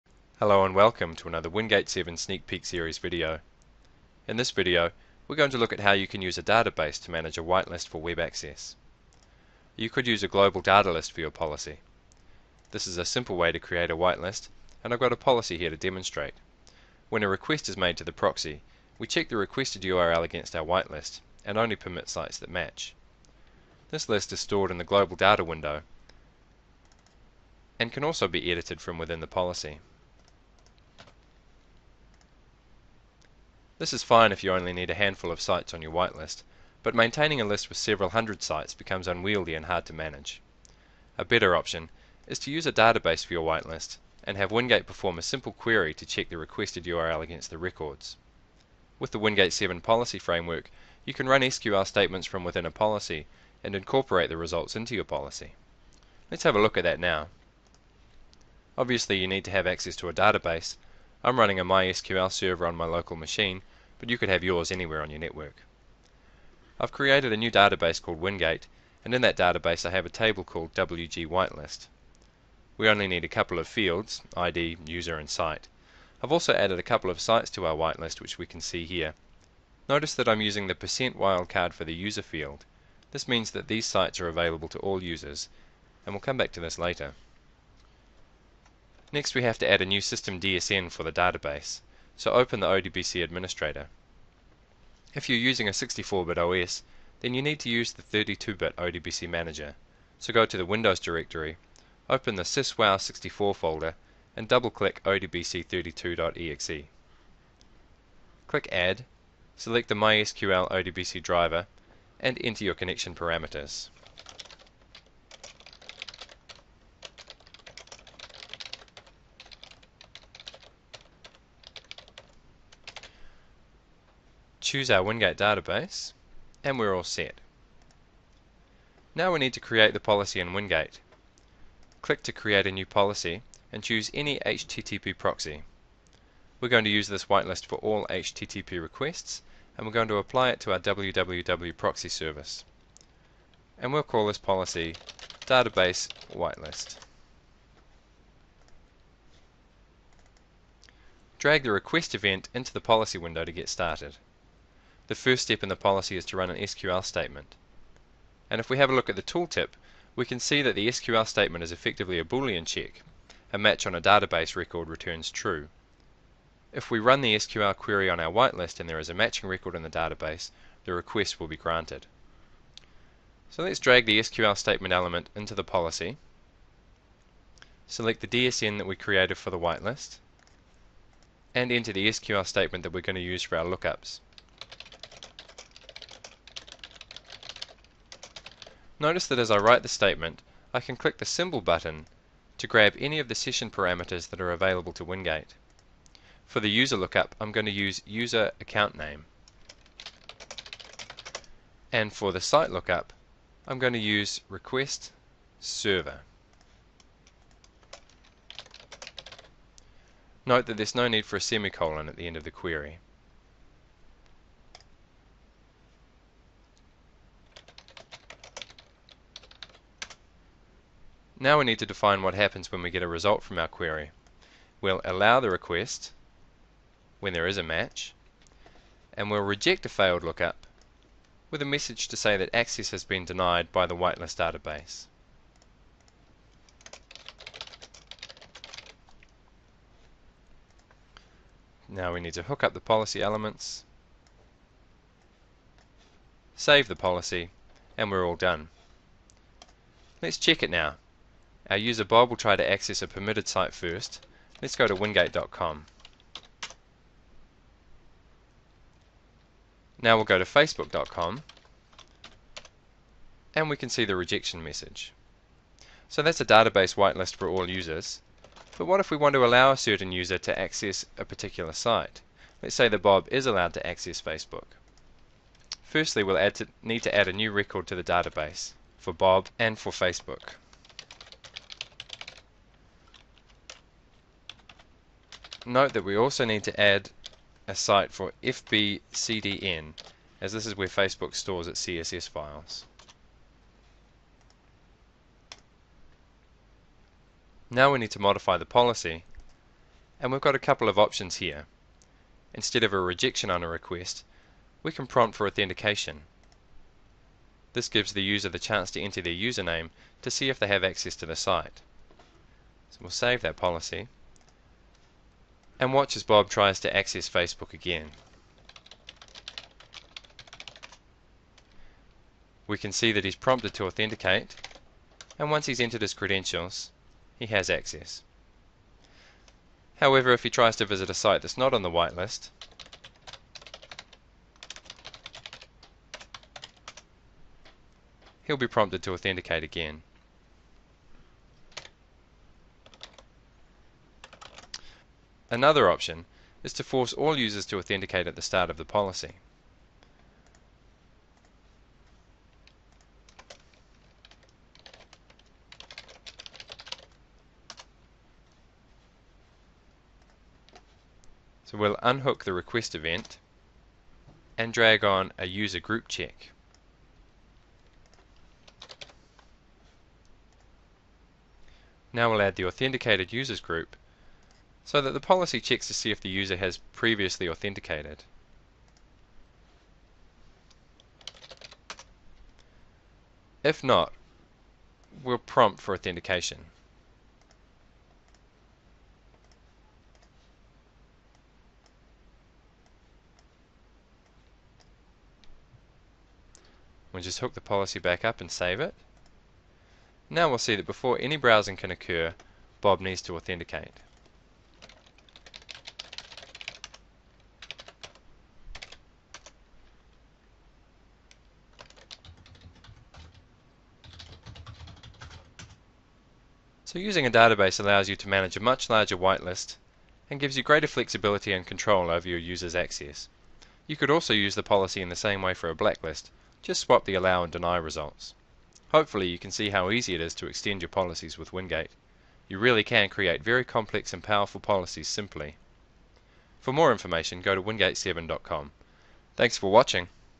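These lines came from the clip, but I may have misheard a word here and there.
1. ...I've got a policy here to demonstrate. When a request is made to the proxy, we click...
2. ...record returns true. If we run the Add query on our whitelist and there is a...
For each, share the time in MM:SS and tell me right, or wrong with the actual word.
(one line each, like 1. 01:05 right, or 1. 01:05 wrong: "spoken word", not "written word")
1. 00:14 wrong: "check", not "click"
2. 02:44 wrong: "SQL", not "Add".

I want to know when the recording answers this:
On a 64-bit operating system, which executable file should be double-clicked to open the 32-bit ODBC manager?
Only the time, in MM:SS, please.
01:45.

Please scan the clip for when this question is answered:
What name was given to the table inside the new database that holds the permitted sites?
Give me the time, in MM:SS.
01:10.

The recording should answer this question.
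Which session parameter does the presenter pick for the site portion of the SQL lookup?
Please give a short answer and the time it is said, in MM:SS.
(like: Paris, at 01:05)
request server, at 03:24.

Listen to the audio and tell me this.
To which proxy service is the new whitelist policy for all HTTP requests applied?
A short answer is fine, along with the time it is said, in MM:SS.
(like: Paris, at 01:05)
www proxy, at 02:20.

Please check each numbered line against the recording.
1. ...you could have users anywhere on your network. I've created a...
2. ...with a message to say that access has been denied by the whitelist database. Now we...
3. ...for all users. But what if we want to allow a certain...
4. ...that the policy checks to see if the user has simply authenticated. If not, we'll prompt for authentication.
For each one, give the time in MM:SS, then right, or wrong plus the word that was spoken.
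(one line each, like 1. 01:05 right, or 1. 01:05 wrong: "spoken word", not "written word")
1. 01:04 wrong: "yours", not "users"
2. 03:51 right
3. 04:27 right
4. 06:14 wrong: "previously", not "simply".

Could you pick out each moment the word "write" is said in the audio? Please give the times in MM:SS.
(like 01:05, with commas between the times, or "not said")
03:09.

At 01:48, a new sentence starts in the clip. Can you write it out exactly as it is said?
Click Add, select the MySQL ODBC driver, and enter your connection parameters.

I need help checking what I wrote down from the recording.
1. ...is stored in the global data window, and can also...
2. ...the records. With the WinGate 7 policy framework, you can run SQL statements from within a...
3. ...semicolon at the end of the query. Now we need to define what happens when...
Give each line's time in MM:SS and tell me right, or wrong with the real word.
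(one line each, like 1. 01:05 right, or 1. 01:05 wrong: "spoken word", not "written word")
1. 00:24 right
2. 00:47 right
3. 03:31 right.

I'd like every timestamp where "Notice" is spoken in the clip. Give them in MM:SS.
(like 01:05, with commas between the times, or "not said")
01:19, 03:09.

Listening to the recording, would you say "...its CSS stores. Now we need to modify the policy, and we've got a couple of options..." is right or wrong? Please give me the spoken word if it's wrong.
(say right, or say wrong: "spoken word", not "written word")
wrong: "files", not "stores".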